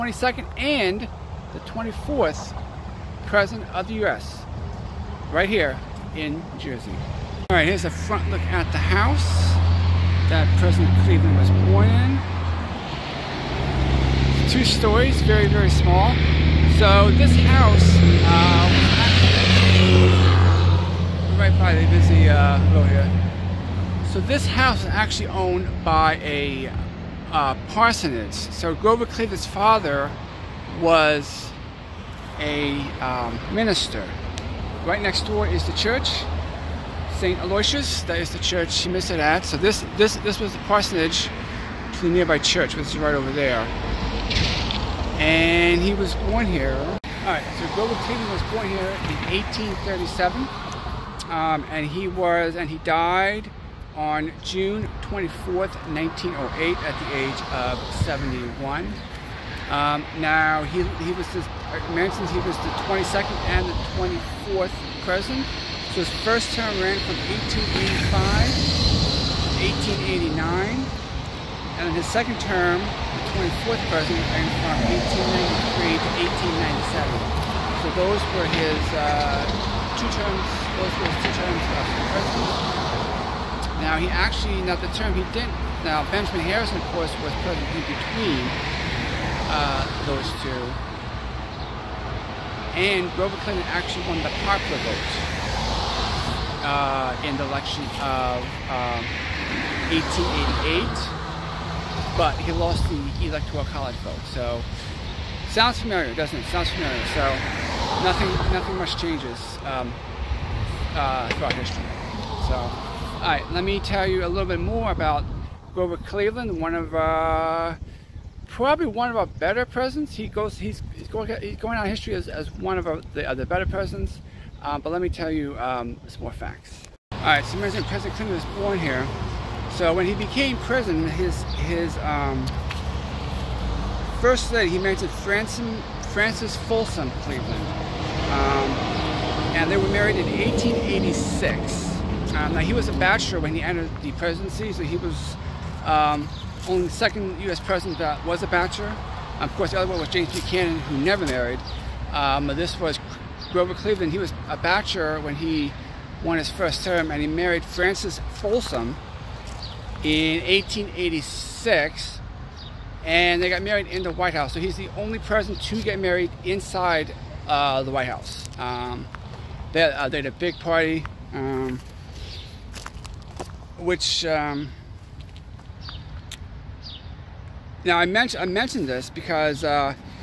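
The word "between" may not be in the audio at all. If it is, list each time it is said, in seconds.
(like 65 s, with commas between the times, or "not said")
87 s.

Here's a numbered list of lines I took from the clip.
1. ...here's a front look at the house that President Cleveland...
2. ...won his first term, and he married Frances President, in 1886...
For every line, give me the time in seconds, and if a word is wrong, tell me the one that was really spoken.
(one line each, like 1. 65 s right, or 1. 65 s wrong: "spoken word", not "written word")
1. 7 s right
2. 156 s wrong: "Folsom", not "President".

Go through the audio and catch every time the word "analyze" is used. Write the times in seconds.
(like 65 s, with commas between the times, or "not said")
not said.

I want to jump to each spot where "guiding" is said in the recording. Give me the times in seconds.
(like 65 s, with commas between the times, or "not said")
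not said.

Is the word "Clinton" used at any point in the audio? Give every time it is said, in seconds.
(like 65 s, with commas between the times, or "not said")
93 s, 127 s.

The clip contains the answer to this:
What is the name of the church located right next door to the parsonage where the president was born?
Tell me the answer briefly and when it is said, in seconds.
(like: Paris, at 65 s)
St. Aloysius, at 37 s.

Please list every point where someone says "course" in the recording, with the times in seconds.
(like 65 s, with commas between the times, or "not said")
86 s, 149 s.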